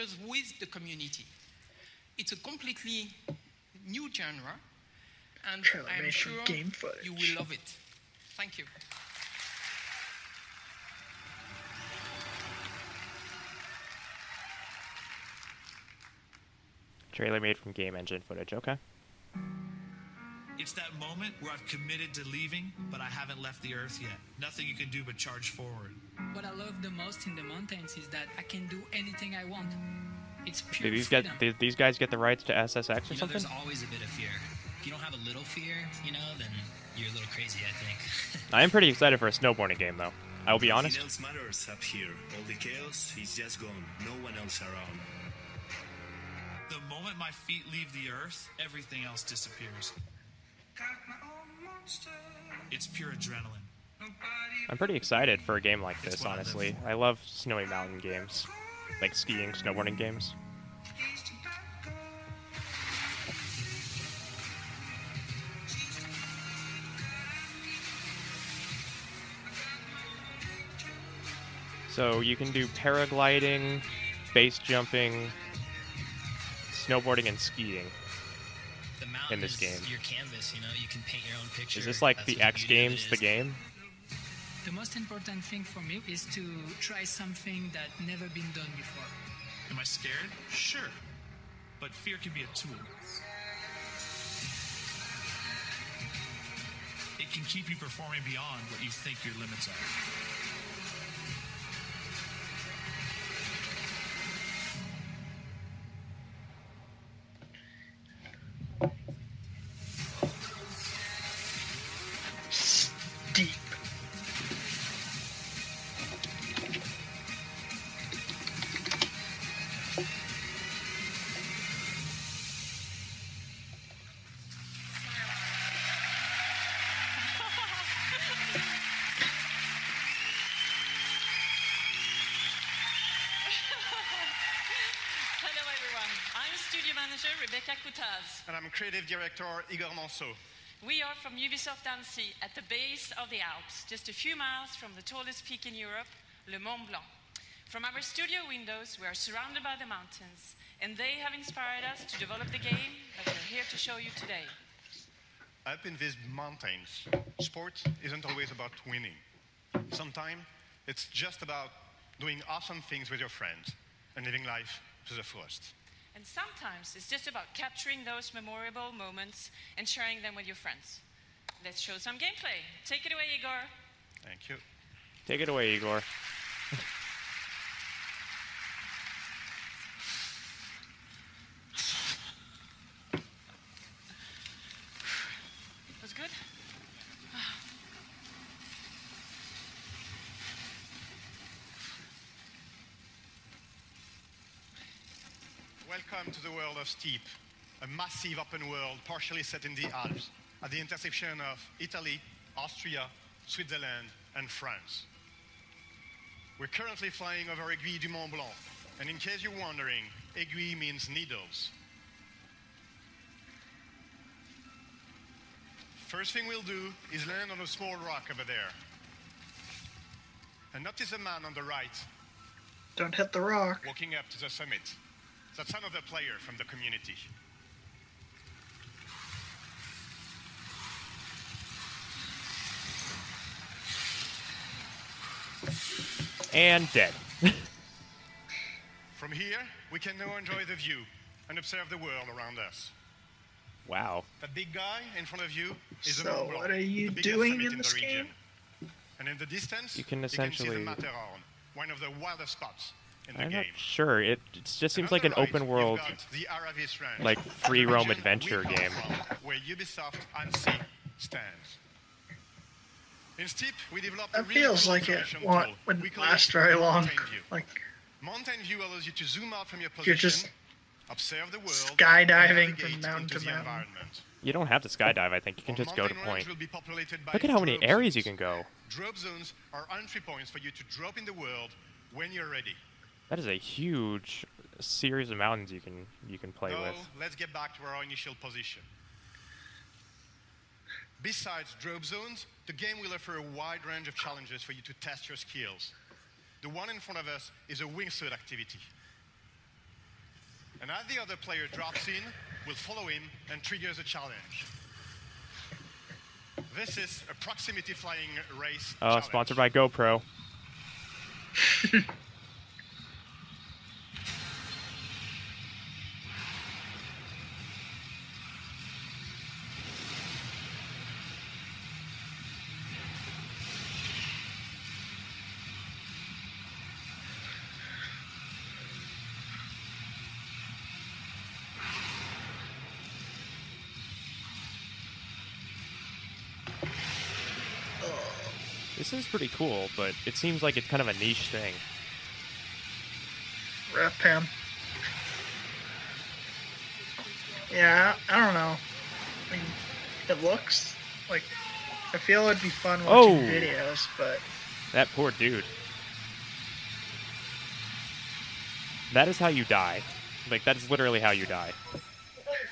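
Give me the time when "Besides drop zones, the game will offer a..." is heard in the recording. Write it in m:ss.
4:51.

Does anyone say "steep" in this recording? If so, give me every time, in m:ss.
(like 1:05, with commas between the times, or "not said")
3:16, 4:23.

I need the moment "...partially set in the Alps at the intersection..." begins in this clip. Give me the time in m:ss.
3:19.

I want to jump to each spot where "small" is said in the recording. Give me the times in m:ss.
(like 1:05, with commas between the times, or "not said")
3:37.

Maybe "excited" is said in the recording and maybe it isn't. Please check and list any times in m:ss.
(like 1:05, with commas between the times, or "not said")
0:38, 0:54.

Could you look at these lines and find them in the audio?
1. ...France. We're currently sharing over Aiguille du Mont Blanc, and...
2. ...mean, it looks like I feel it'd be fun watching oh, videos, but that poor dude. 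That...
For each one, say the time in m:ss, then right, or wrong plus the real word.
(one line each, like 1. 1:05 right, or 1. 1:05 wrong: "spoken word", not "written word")
1. 3:24 wrong: "flying", not "sharing"
2. 5:49 right.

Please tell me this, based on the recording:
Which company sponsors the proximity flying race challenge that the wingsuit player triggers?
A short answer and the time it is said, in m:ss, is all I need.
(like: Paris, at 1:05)
GoPro, at 5:09.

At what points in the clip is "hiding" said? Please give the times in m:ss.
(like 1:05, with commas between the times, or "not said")
not said.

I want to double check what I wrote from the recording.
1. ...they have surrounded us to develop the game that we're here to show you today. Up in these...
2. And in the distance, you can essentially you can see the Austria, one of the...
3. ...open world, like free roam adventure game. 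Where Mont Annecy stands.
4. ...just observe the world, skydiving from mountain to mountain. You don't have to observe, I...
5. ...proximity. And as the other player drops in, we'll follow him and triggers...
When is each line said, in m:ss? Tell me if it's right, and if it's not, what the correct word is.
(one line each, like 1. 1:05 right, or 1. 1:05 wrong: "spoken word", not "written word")
1. 2:30 wrong: "inspired", not "surrounded"
2. 4:09 wrong: "Matterhorn", not "Austria"
3. 4:15 wrong: "Ubisoft", not "Mont"
4. 4:30 wrong: "skydive", not "observe"
5. 4:58 wrong: "activity", not "proximity".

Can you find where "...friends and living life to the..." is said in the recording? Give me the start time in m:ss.
2:43.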